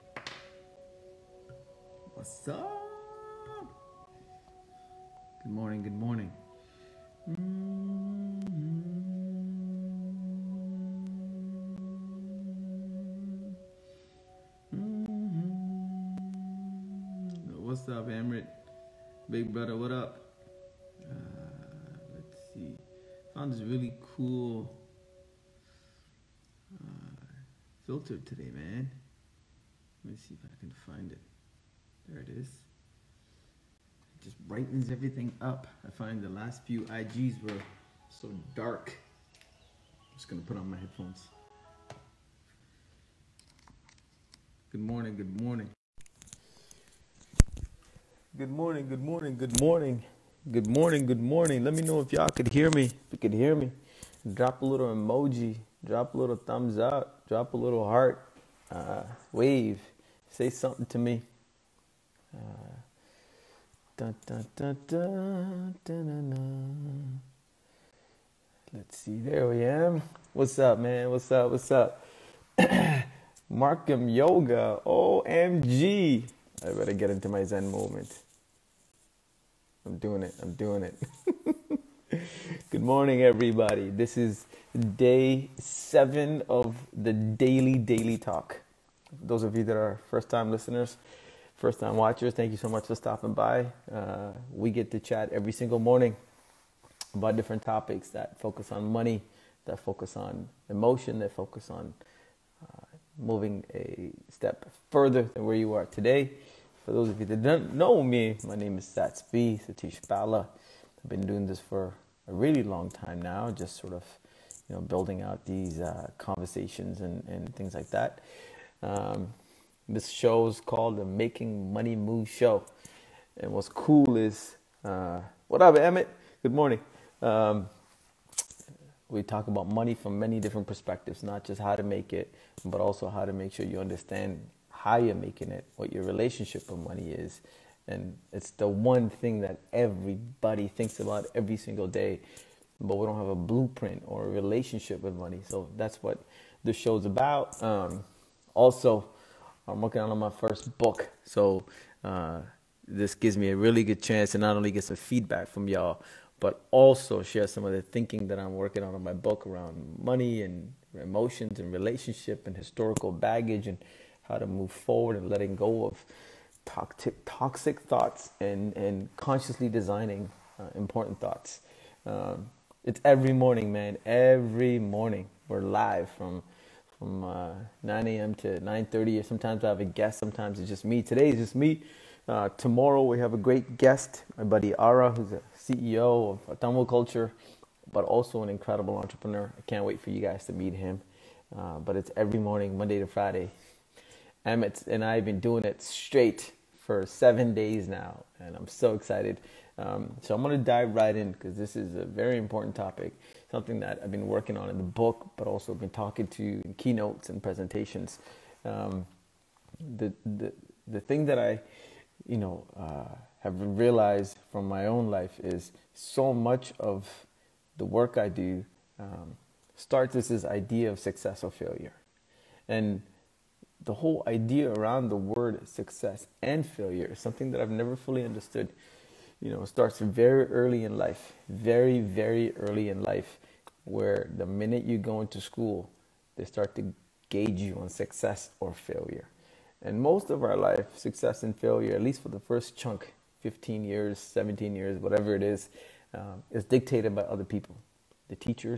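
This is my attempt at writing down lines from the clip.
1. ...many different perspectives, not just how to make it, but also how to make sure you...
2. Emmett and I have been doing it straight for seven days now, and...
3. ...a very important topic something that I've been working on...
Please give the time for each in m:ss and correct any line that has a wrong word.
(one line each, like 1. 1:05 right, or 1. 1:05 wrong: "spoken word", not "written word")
1. 2:10 right
2. 3:14 right
3. 3:21 right.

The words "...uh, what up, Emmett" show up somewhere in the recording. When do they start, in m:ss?
2:04.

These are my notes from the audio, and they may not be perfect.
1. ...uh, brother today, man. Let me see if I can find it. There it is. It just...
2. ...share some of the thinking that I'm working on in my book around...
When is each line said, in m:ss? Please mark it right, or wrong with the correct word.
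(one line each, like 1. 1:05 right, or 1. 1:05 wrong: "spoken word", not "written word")
1. 0:26 wrong: "filter", not "brother"
2. 2:37 right.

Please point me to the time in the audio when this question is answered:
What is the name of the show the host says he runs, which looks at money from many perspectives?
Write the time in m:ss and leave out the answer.
2:01.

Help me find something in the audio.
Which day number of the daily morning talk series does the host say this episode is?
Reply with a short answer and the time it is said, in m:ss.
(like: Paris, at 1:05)
7, at 1:24.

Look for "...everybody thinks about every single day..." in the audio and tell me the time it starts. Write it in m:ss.
2:19.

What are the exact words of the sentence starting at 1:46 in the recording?
For those of you that don't know me, my name is Sats B, Sathish Bala.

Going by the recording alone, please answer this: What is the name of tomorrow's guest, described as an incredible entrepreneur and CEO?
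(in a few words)
Ara.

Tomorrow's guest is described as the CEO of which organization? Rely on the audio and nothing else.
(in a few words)
Tamil Culture.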